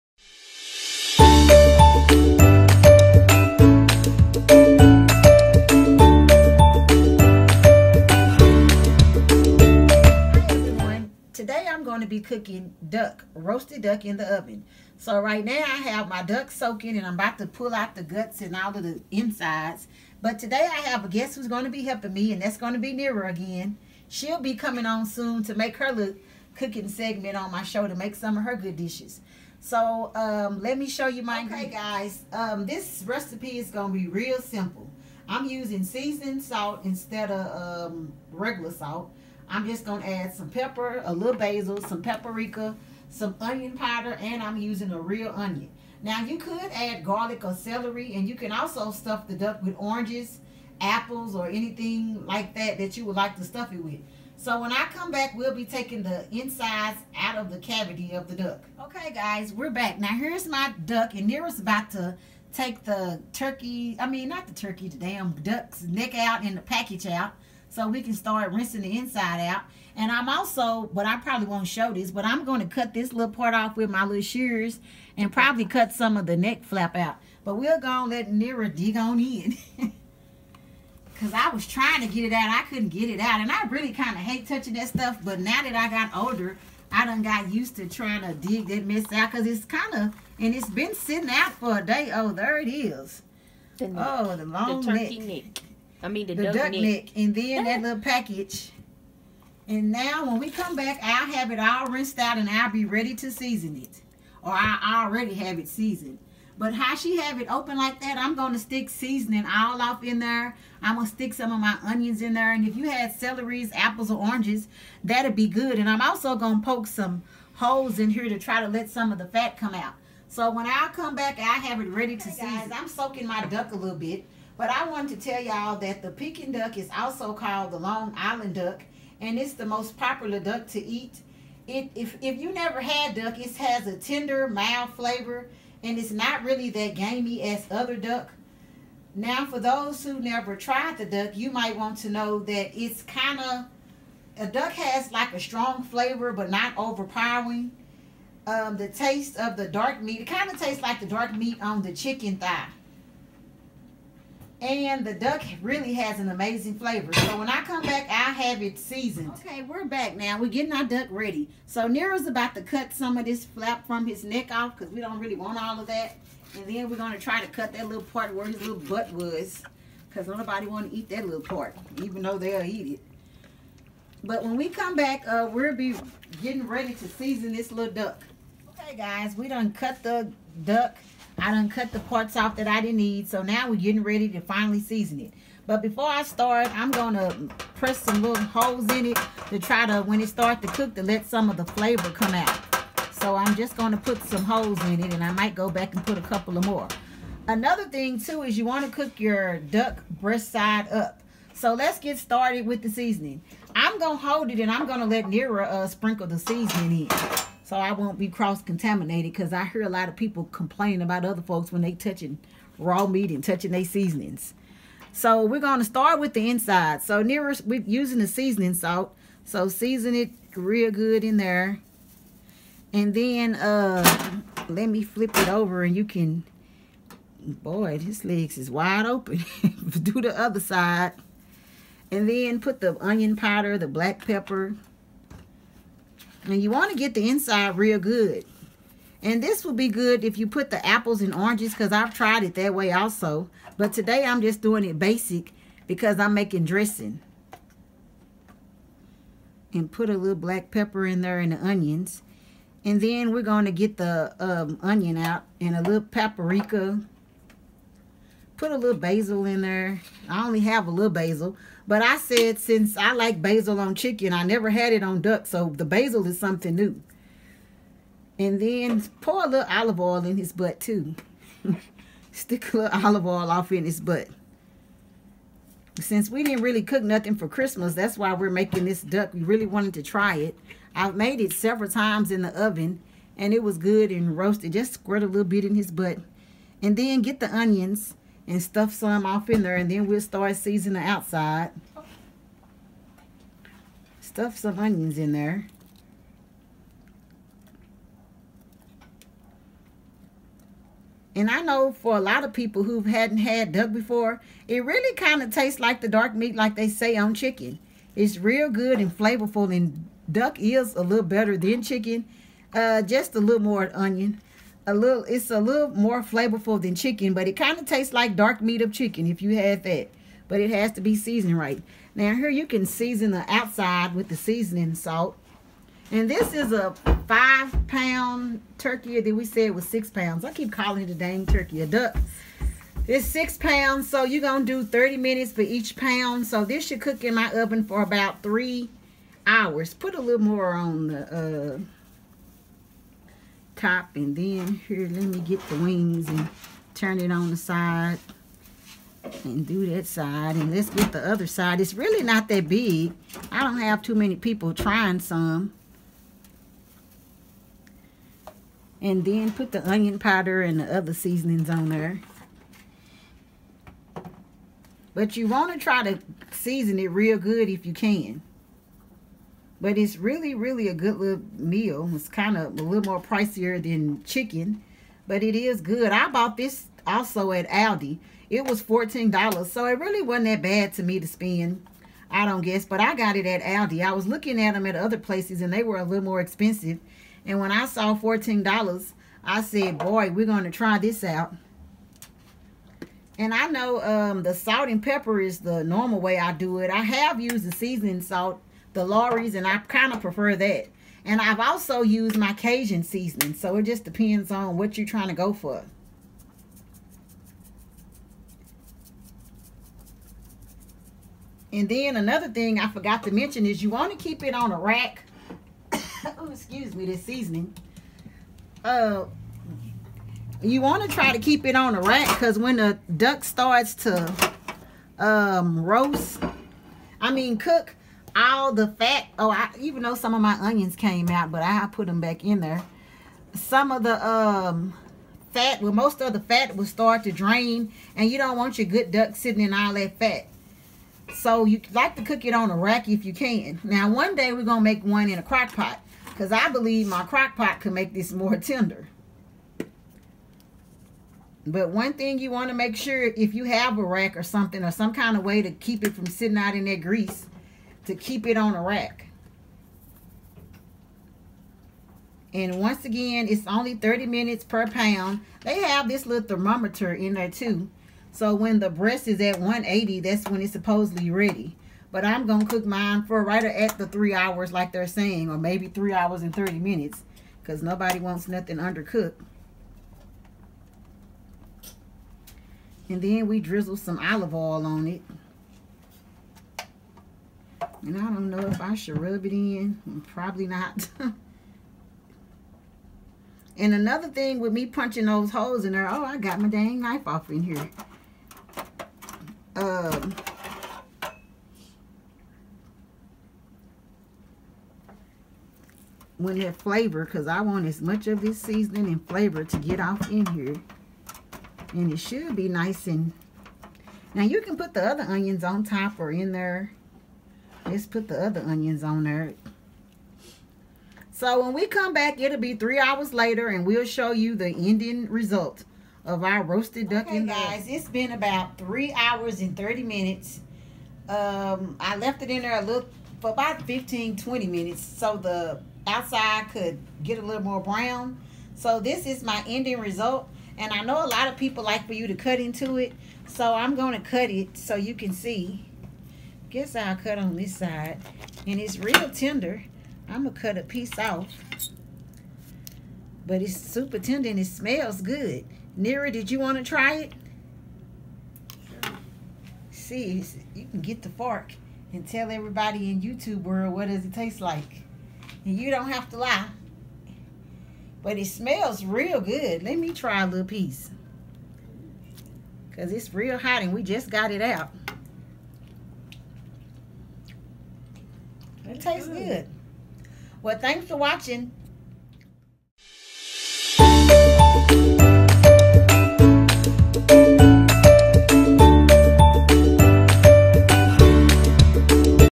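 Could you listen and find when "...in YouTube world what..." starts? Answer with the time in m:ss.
9:23.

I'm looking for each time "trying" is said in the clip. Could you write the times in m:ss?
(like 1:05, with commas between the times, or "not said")
1:21, 1:27, 5:54, 6:45.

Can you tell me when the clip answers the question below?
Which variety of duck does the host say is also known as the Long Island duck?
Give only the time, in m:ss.
2:06.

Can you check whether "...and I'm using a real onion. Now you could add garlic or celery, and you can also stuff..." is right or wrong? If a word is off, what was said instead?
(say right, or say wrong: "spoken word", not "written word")
right.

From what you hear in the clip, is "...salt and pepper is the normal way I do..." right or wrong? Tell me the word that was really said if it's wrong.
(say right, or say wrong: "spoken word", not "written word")
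right.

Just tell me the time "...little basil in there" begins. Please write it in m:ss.
4:18.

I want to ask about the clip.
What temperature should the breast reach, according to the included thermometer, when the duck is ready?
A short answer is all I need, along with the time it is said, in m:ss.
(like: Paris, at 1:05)
180, at 7:49.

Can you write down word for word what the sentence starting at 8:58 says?
So this is my ending result.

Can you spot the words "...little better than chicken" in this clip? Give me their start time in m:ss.
5:11.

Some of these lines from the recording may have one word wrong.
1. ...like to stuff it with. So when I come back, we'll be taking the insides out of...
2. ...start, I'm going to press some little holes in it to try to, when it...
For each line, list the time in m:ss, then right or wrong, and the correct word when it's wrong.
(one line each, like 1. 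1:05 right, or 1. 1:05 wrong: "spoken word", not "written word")
1. 0:53 right
2. 3:06 right.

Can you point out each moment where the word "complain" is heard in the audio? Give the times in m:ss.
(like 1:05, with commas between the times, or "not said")
3:30.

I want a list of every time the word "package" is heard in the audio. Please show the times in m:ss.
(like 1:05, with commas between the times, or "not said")
1:06, 1:37.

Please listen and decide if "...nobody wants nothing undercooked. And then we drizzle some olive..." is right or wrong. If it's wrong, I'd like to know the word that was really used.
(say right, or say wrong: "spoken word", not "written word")
right.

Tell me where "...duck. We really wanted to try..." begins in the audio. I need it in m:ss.
4:39.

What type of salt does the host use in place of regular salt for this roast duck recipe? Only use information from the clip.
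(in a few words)
seasoned salt.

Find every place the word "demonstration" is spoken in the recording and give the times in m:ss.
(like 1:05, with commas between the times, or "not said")
not said.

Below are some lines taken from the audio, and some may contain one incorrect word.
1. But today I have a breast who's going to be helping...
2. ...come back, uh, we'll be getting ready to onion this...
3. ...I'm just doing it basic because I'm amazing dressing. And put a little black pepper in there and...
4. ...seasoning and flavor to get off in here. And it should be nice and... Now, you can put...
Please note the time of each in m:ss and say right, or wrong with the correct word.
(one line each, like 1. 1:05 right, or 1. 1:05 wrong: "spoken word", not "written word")
1. 0:20 wrong: "guest", not "breast"
2. 2:54 wrong: "season", not "onion"
3. 4:04 wrong: "making", not "amazing"
4. 8:28 right.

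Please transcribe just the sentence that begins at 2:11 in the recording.
It, if, if you never had duck, it has a tender, mild flavor, and it's not really that gamey as other duck.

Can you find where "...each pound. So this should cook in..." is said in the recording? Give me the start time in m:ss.
5:35.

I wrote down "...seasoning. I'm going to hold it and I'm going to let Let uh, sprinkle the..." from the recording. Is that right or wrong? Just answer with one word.
wrong.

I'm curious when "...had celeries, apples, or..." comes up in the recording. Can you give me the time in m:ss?
1:52.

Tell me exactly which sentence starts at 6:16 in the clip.
I bought this also at Aldi.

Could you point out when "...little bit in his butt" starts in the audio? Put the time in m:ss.
4:45.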